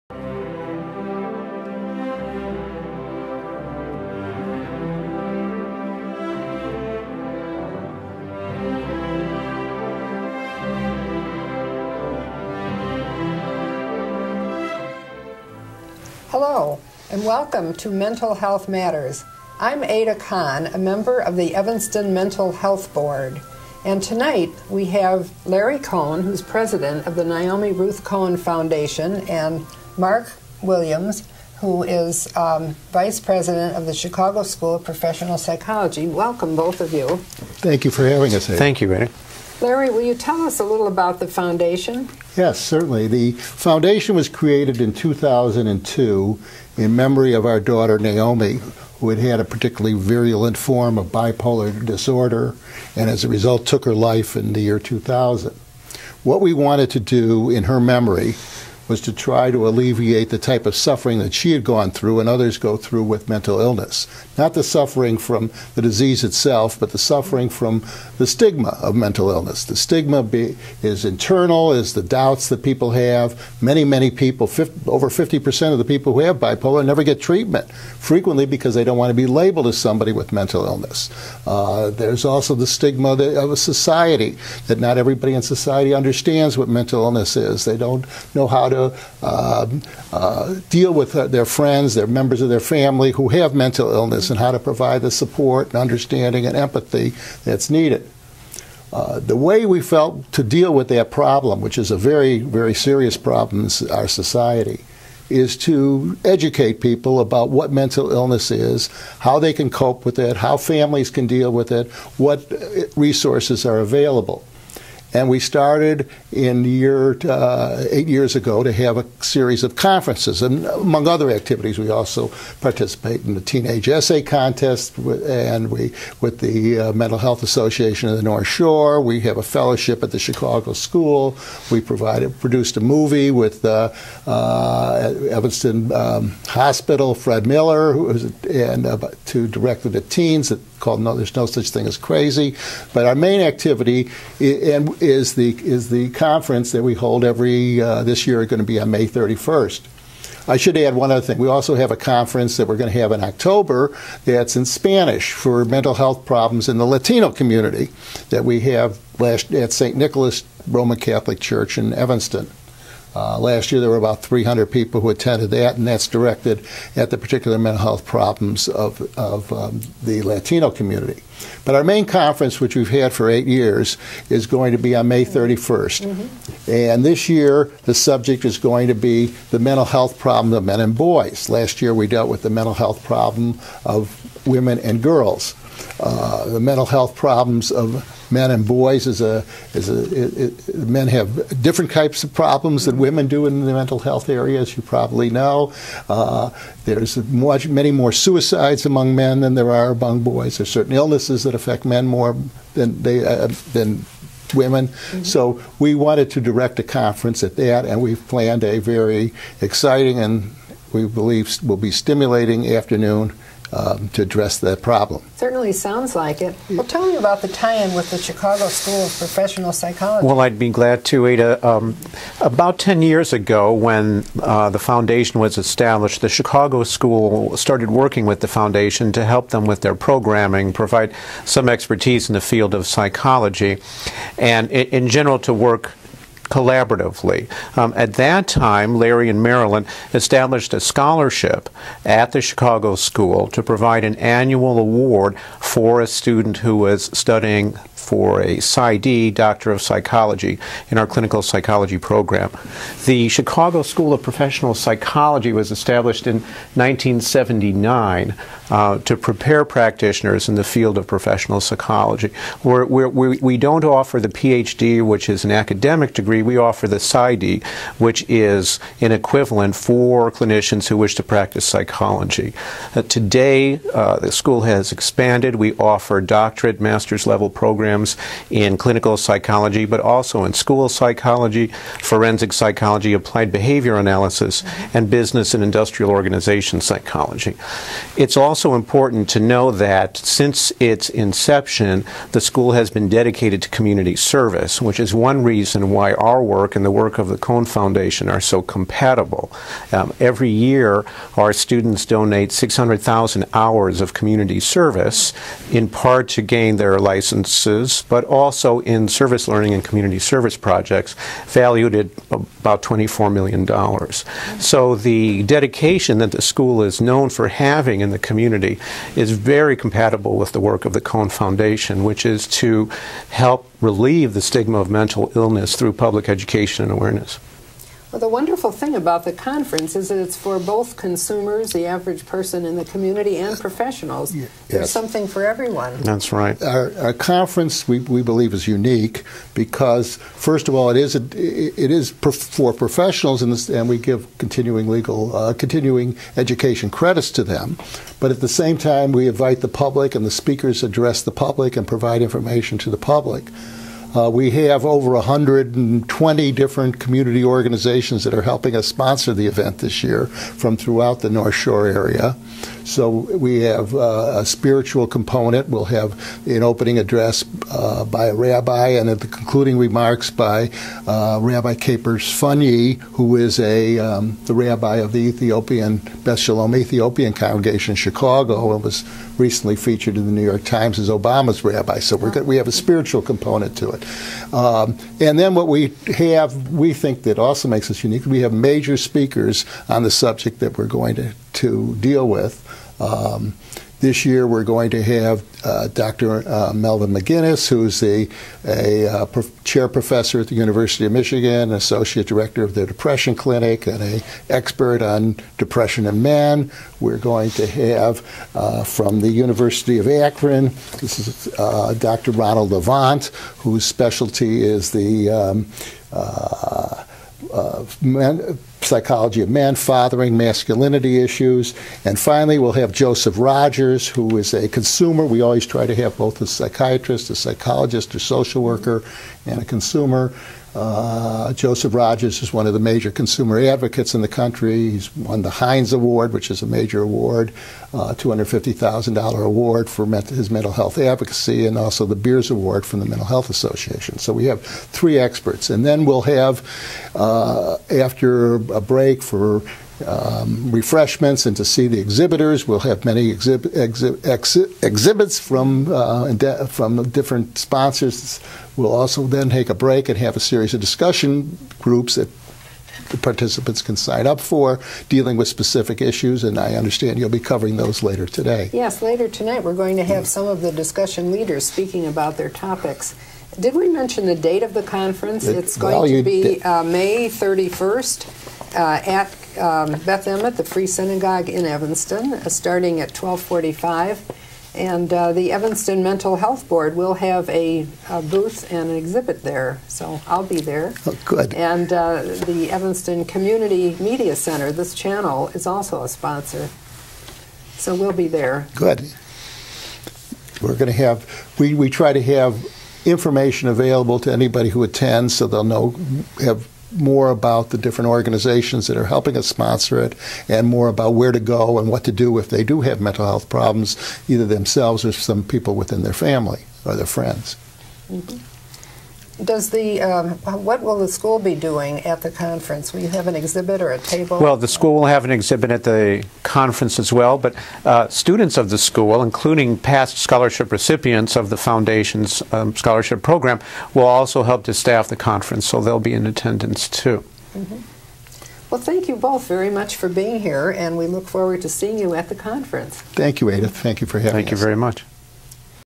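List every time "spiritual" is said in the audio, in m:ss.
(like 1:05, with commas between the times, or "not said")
6:04, 6:22.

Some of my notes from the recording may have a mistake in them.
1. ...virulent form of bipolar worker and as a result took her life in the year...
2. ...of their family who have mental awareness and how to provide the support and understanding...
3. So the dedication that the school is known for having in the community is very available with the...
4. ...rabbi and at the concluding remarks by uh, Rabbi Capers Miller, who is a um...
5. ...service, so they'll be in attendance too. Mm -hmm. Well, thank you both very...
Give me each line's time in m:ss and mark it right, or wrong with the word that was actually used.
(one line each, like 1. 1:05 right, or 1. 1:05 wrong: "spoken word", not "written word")
1. 0:49 wrong: "disorder", not "worker"
2. 1:32 wrong: "illness", not "awareness"
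3. 5:14 wrong: "compatible", not "available"
4. 6:08 wrong: "Funnye", not "Miller"
5. 8:55 wrong: "conference", not "service".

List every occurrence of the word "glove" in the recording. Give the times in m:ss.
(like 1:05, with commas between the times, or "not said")
not said.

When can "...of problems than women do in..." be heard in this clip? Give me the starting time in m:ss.
3:12.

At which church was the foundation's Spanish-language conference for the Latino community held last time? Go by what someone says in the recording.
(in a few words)
St. Nicholas Roman Catholic Church.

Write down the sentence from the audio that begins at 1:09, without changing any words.
The stigma be, is internal, is the doubts that people have.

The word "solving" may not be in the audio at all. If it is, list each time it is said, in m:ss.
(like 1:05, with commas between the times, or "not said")
not said.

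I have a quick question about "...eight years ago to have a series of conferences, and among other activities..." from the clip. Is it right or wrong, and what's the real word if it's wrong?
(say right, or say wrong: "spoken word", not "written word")
right.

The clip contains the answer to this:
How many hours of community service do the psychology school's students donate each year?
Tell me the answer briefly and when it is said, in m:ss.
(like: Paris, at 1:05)
600,000, at 5:02.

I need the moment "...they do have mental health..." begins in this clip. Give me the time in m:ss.
8:32.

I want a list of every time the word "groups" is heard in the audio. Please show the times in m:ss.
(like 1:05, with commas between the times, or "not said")
7:41.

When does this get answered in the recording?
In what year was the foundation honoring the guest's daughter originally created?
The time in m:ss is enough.
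0:44.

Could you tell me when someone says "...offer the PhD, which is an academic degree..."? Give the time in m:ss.
4:23.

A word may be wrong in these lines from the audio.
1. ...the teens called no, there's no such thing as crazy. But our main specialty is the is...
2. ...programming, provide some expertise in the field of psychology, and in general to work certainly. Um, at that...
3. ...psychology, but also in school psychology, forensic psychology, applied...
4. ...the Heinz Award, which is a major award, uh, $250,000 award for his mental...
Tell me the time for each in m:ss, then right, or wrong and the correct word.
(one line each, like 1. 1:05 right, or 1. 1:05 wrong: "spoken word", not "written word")
1. 2:19 wrong: "activity", not "specialty"
2. 3:49 wrong: "collaboratively", not "certainly"
3. 4:39 right
4. 7:15 right.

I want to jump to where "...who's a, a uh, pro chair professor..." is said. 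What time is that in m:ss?
6:37.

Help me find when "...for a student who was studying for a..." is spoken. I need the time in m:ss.
4:05.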